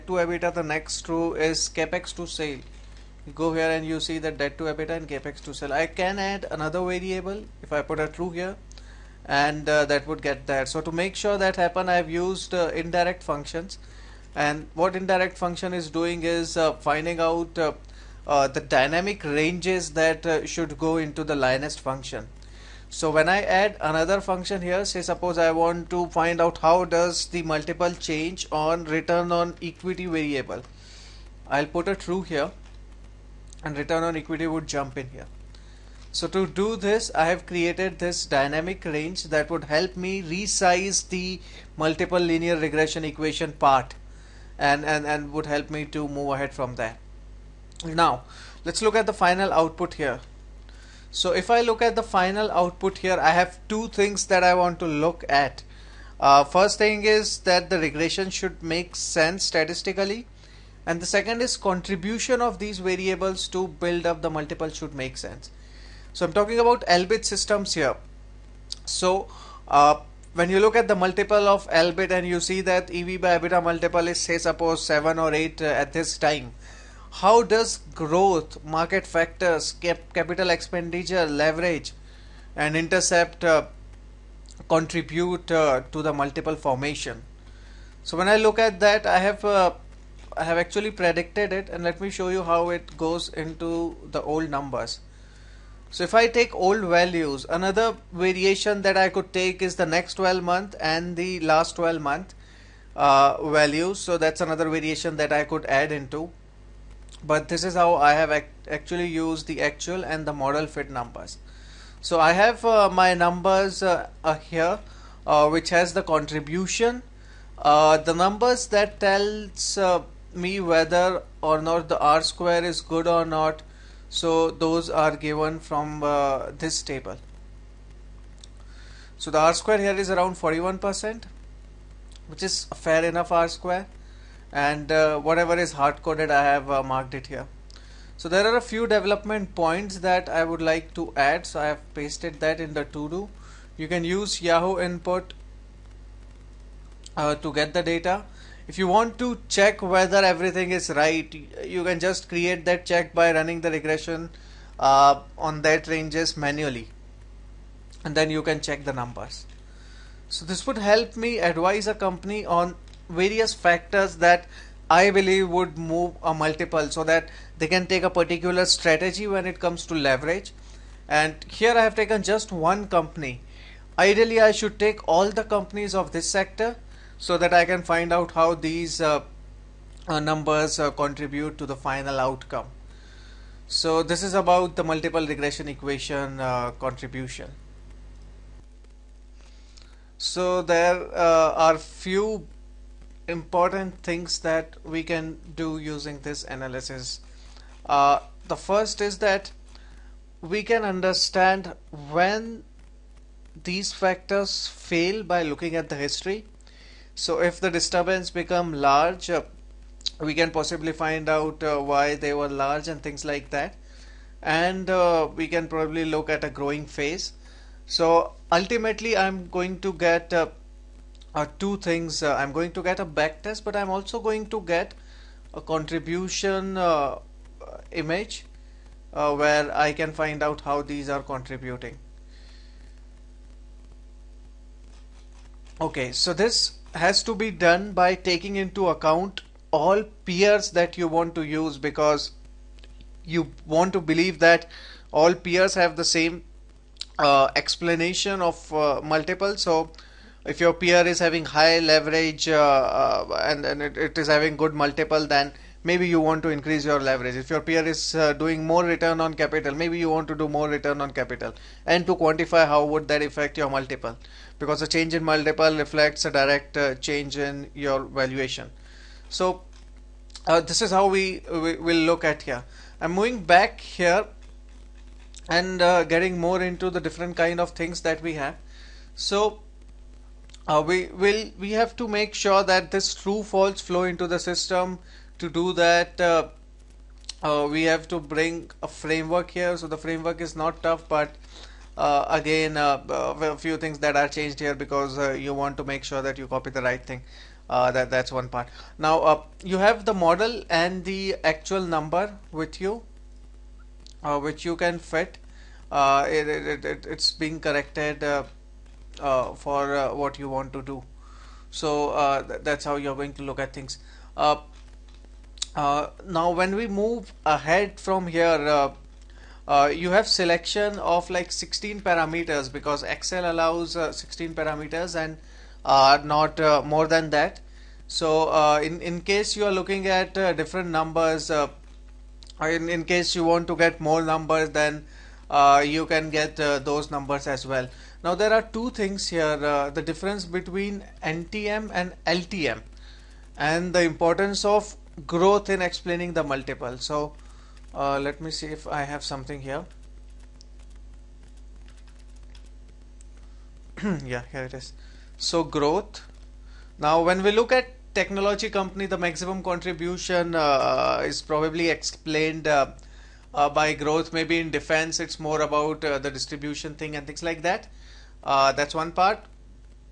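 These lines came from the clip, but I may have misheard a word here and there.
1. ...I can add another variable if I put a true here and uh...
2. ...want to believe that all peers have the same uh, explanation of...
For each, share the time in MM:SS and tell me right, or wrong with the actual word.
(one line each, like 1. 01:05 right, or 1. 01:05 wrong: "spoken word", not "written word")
1. 00:05 right
2. 04:03 right.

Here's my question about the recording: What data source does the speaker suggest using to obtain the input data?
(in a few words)
Yahoo.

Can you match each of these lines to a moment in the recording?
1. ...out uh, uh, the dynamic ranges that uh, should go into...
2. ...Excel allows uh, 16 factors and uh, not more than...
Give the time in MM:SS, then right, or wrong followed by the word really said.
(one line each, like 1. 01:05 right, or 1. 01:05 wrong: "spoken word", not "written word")
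1. 00:17 right
2. 05:23 wrong: "parameters", not "factors".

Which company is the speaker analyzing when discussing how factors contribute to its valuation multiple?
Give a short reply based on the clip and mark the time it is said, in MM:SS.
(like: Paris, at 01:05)
Elbit Systems, at 01:06.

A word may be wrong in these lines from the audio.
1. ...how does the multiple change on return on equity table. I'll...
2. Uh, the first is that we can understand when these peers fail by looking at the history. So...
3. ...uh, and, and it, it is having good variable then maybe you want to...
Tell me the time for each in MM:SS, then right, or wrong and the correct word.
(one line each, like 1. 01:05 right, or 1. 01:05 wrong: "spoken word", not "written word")
1. 00:26 wrong: "variable", not "table"
2. 03:17 wrong: "factors", not "peers"
3. 04:12 wrong: "multiple", not "variable".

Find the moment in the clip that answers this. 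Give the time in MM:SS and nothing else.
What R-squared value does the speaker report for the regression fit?
02:10.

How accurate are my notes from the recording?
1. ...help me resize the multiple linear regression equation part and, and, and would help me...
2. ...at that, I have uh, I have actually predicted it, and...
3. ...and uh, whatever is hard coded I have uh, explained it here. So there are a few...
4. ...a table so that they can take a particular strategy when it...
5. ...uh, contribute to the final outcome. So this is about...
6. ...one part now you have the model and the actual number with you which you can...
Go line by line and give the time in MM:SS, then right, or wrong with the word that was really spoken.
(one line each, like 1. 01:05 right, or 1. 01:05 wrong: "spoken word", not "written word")
1. 00:39 right
2. 01:28 right
3. 02:14 wrong: "marked", not "explained"
4. 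02:46 wrong: "multiple", not "table"
5. 03:00 right
6. 04:58 right.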